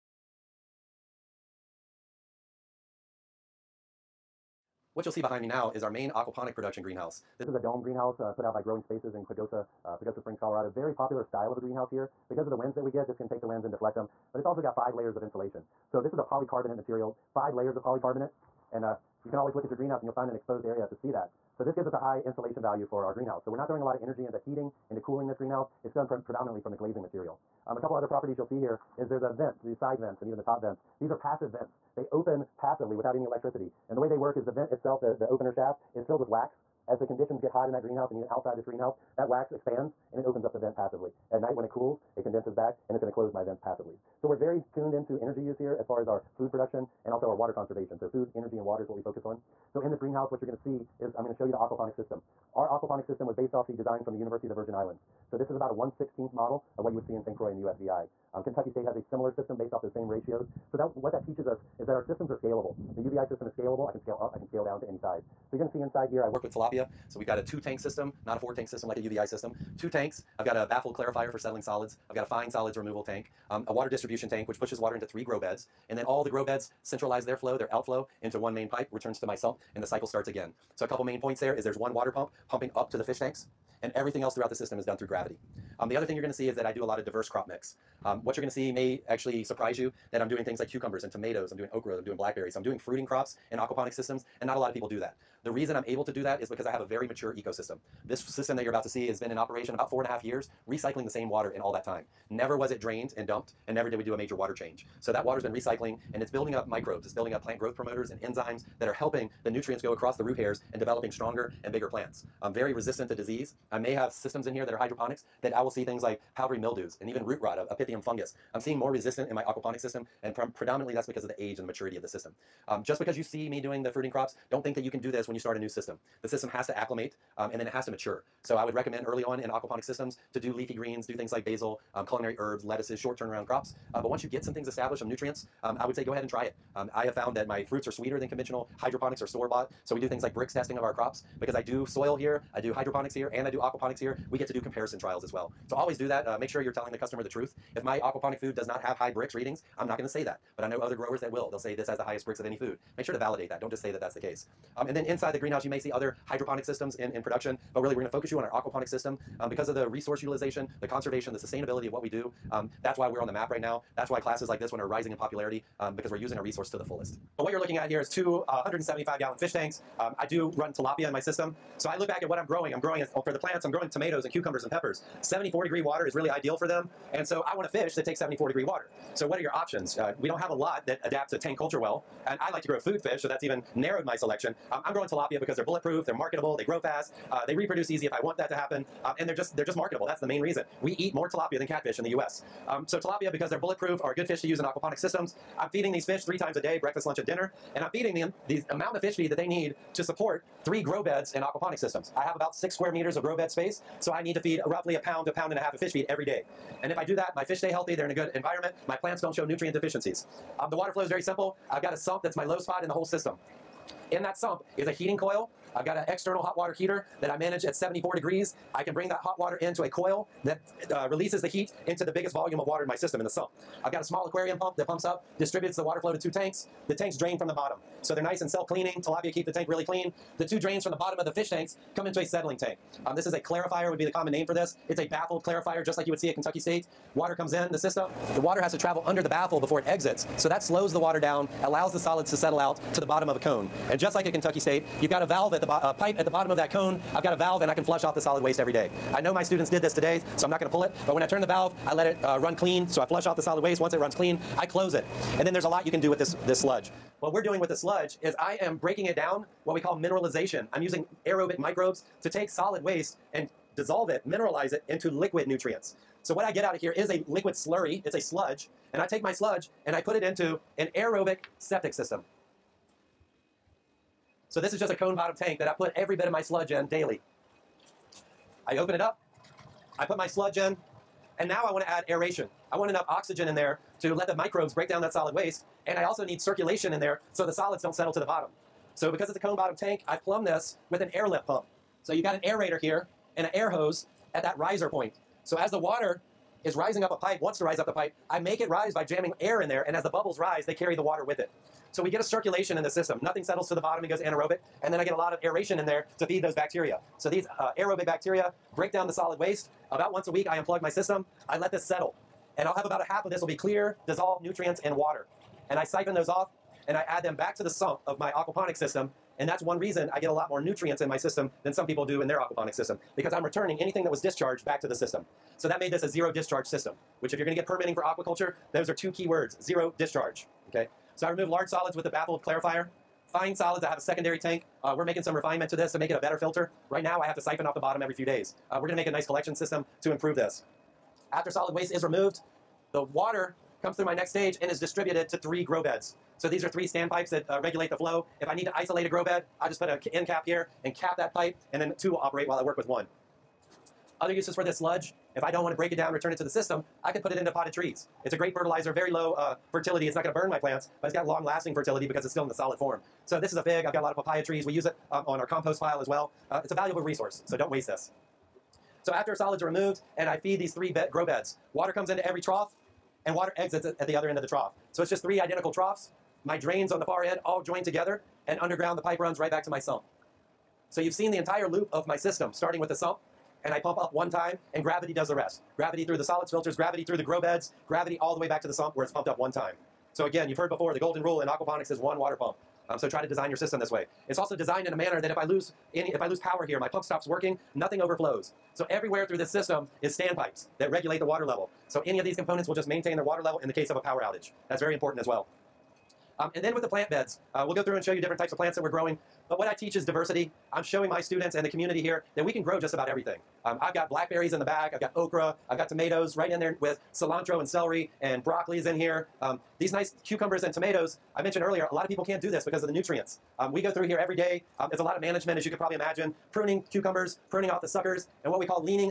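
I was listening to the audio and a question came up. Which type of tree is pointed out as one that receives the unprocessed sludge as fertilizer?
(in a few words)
Fig.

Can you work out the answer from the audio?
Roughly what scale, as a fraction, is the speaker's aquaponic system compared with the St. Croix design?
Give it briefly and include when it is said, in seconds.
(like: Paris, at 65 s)
1/16, at 55 s.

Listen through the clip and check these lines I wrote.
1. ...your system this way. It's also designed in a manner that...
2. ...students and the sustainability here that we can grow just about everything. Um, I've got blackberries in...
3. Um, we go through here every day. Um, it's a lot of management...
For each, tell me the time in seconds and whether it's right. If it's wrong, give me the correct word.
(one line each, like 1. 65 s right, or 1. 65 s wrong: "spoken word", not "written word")
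1. 393 s right
2. 411 s wrong: "community", not "sustainability"
3. 423 s right.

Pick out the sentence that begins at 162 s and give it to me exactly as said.
Um, that's why we're on the map right now.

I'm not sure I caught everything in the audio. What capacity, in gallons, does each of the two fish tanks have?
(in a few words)
175 gallons.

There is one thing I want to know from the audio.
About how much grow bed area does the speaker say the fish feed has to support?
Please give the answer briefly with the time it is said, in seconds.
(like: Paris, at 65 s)
6 square meters, at 202 s.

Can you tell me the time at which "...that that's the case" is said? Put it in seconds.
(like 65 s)
153 s.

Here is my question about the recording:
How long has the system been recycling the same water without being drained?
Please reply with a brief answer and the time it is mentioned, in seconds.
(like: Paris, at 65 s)
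About four and a half years, at 99 s.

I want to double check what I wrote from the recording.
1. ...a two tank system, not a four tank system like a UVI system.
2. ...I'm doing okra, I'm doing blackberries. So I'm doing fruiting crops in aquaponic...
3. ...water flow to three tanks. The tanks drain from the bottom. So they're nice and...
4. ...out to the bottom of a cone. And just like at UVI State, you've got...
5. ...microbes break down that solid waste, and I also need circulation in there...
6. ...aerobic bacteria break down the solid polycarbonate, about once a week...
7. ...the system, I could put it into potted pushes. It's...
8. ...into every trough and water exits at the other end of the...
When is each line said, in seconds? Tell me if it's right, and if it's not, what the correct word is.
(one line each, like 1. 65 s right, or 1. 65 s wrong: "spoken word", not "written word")
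1. 67 s right
2. 91 s right
3. 225 s wrong: "two", not "three"
4. 242 s wrong: "Kentucky", not "UVI"
5. 284 s right
6. 307 s wrong: "waste", not "polycarbonate"
7. 356 s wrong: "trees", not "pushes"
8. 372 s right.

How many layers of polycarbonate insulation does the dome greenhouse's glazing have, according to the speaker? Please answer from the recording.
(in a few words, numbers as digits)
5.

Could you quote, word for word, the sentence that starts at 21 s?
So this gives us a high insulation value for our greenhouse.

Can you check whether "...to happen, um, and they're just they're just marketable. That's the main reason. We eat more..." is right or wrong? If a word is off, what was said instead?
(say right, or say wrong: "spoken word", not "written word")
right.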